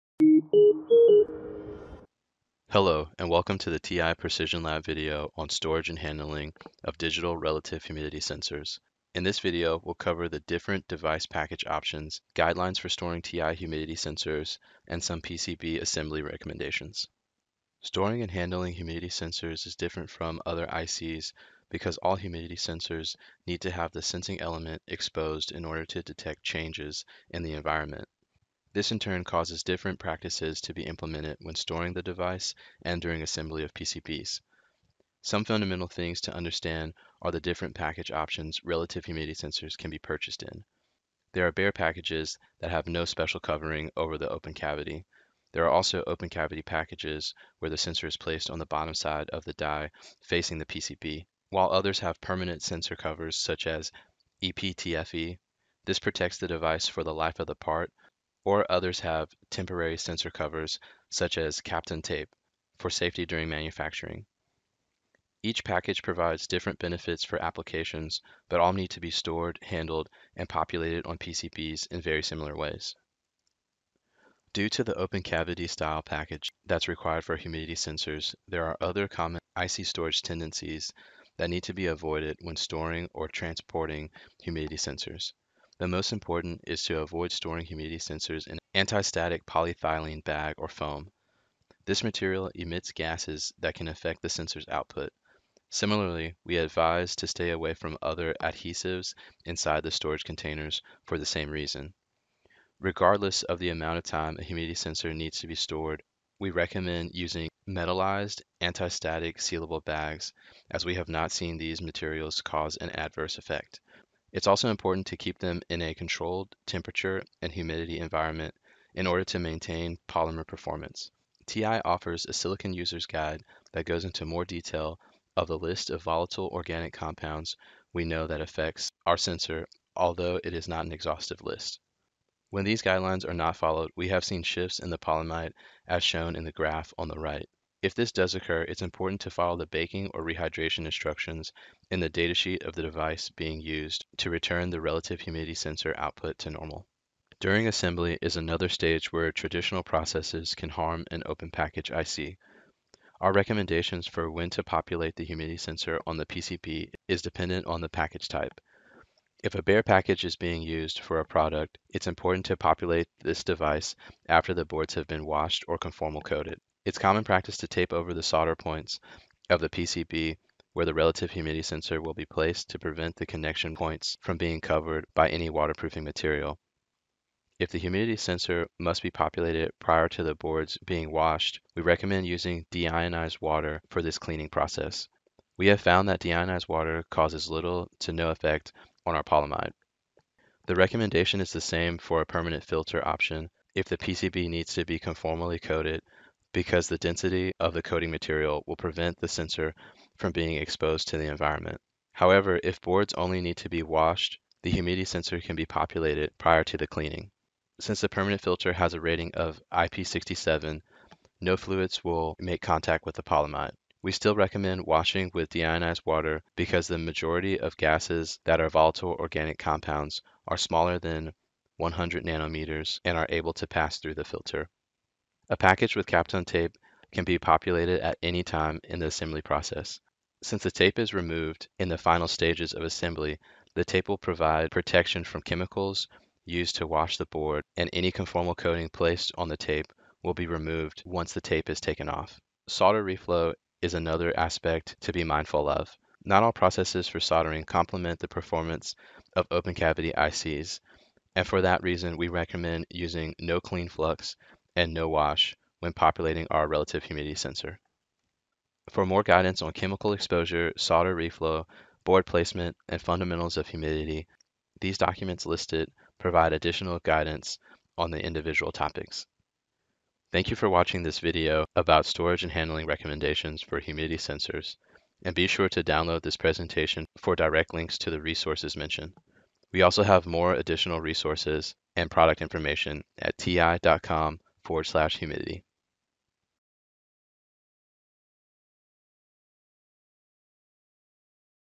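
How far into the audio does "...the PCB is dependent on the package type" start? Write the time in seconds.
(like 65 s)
156 s.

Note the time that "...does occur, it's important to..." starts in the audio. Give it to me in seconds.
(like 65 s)
138 s.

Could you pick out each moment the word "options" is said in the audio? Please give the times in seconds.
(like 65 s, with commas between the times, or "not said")
11 s, 38 s, 193 s.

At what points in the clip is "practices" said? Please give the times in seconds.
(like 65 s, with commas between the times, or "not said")
29 s, 167 s.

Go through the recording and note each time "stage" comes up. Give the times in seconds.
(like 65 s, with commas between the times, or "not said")
148 s, 232 s.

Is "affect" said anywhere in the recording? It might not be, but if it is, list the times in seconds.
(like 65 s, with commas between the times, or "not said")
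93 s, 128 s.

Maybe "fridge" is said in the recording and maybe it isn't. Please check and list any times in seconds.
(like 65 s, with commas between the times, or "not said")
not said.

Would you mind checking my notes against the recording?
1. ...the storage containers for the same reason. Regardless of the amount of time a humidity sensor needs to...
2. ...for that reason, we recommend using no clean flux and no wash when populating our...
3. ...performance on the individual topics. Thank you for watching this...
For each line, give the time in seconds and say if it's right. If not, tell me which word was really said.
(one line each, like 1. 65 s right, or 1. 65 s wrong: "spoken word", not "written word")
1. 99 s right
2. 251 s right
3. 266 s wrong: "guidance", not "performance".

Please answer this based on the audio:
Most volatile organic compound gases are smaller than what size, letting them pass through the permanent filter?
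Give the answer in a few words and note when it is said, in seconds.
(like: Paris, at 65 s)
100 nanometers, at 221 s.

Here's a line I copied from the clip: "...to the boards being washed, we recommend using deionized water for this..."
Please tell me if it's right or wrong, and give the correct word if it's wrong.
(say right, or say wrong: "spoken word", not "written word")
right.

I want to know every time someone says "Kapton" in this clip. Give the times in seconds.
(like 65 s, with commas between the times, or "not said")
61 s, 226 s.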